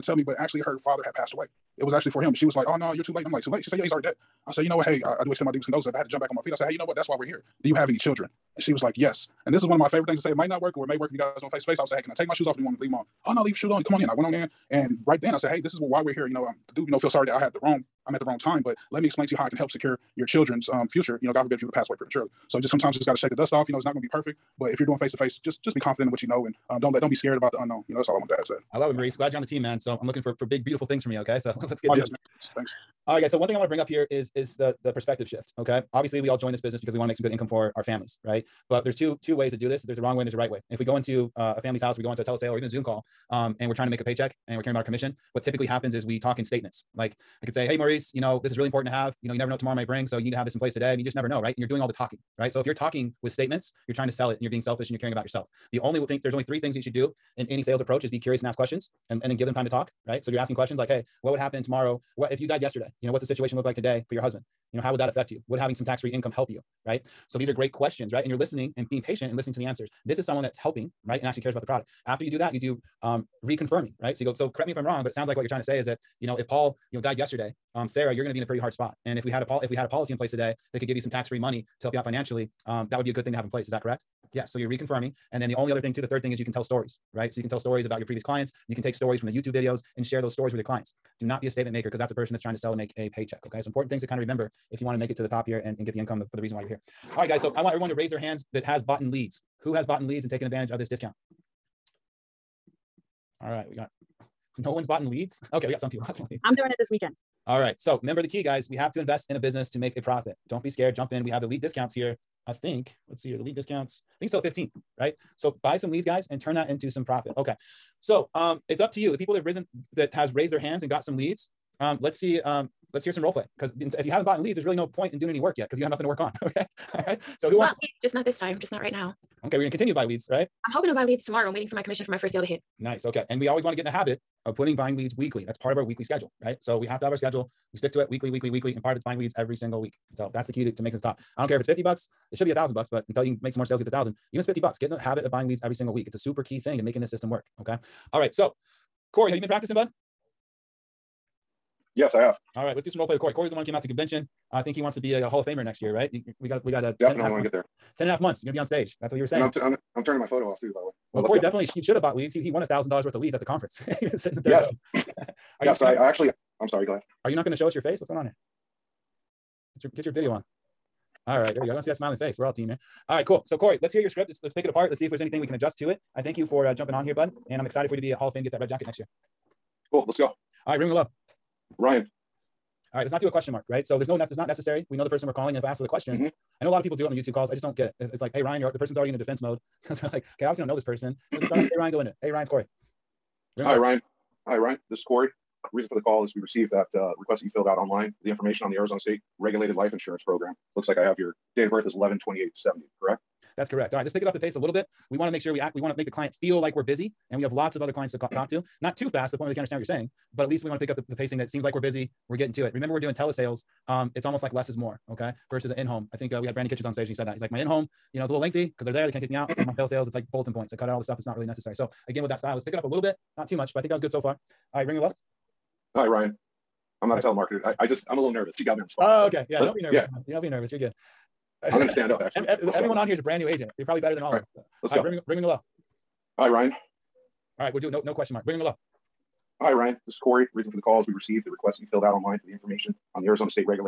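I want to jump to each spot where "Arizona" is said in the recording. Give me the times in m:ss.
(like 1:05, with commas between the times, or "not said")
3:18, 4:03.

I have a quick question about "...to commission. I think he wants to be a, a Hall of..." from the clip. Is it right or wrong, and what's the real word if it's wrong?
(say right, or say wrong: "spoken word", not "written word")
wrong: "convention", not "commission".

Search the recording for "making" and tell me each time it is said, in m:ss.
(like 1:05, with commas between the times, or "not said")
2:20, 2:26.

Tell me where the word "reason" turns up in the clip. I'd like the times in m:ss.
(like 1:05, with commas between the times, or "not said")
1:36, 3:15, 4:00.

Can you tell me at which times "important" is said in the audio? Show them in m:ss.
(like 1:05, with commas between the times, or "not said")
0:48, 1:33.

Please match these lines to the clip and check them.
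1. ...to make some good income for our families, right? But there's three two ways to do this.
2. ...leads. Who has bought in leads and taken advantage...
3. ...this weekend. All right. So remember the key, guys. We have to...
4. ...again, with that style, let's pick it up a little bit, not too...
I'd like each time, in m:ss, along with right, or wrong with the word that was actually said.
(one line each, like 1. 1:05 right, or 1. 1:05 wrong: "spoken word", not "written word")
1. 0:37 wrong: "two", not "three"
2. 1:39 right
3. 1:46 right
4. 3:42 right.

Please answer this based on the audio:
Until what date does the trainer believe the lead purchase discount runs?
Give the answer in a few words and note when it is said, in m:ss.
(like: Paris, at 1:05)
the 15th, at 1:54.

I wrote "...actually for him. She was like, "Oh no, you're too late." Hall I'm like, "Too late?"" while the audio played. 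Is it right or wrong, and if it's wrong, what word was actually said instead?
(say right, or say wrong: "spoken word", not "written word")
wrong: "And", not "Hall".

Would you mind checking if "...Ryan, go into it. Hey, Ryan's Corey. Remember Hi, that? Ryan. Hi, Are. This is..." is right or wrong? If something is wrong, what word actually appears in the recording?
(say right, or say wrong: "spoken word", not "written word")
wrong: "Ryan", not "Are".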